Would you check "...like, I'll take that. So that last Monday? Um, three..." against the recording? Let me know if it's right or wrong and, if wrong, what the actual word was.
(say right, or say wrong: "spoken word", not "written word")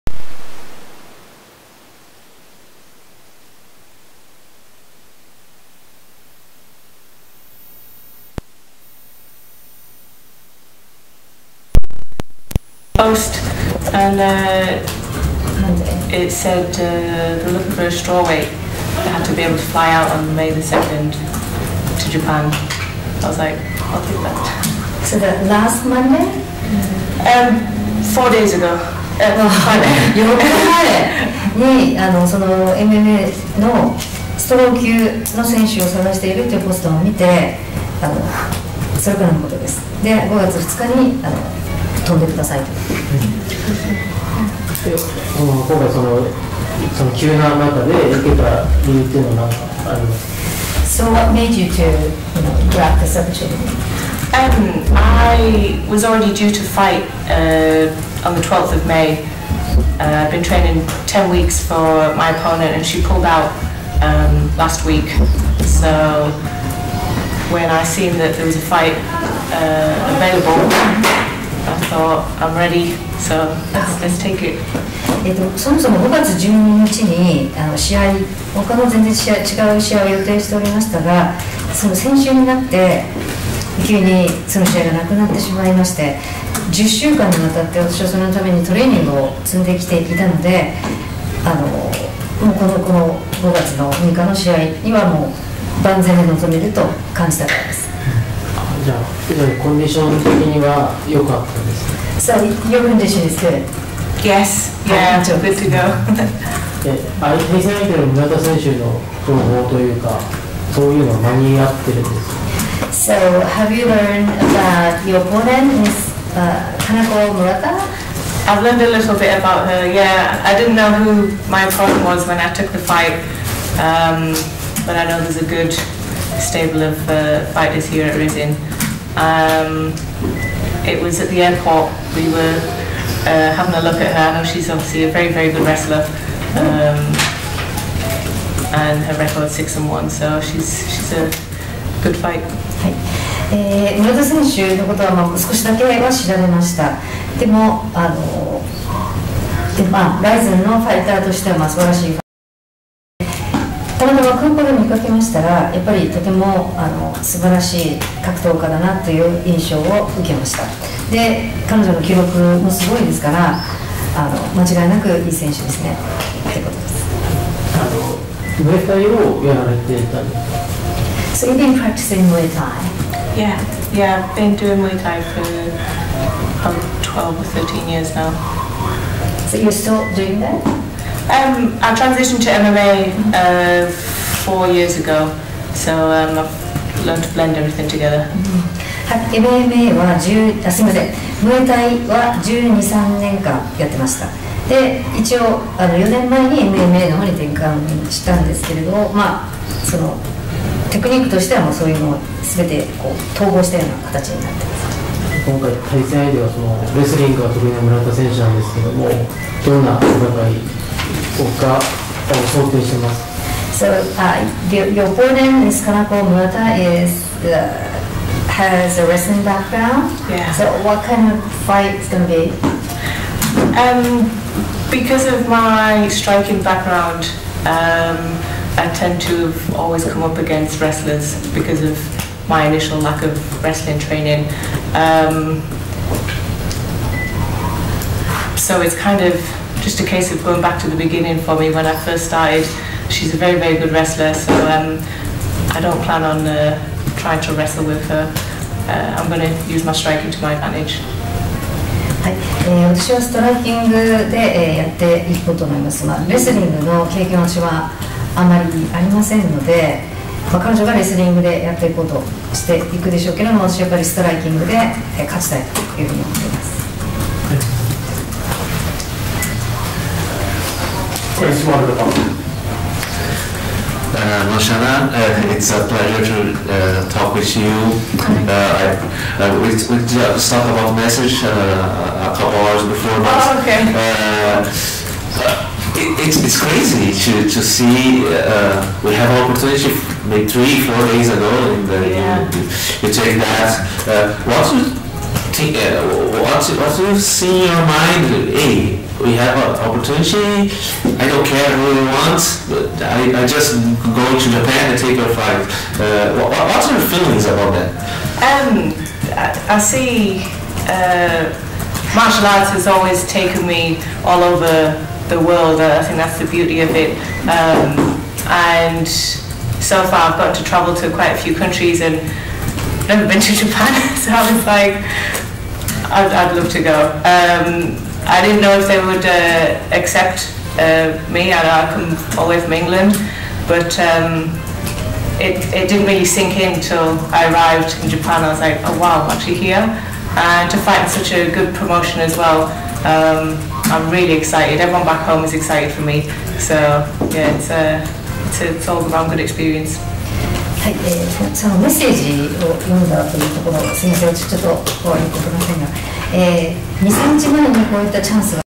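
wrong: "four", not "three".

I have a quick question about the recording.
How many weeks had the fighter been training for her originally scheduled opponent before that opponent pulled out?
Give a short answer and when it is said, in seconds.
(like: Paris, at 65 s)
10, at 61 s.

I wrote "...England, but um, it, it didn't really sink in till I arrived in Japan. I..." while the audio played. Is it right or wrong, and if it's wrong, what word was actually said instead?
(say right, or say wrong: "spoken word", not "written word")
right.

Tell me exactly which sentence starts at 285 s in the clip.
it, it's, it's crazy to, to see.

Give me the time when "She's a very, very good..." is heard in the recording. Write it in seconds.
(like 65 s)
243 s.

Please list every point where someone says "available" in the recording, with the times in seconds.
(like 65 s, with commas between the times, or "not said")
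70 s.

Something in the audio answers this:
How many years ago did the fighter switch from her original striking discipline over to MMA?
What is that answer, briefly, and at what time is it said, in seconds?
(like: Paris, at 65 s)
4, at 184 s.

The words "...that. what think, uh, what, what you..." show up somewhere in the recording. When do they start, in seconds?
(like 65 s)
293 s.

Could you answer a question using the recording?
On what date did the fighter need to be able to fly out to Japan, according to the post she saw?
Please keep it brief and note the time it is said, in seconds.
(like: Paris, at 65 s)
May 2nd, at 20 s.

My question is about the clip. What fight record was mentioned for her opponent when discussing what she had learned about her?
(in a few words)
6 and 1.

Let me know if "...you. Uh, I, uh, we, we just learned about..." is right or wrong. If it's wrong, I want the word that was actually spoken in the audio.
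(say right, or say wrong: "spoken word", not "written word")
wrong: "talked", not "learned".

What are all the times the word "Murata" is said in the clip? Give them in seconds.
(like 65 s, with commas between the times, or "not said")
117 s, 216 s.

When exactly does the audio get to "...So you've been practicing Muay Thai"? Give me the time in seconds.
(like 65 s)
171 s.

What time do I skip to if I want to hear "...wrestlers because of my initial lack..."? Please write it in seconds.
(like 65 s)
230 s.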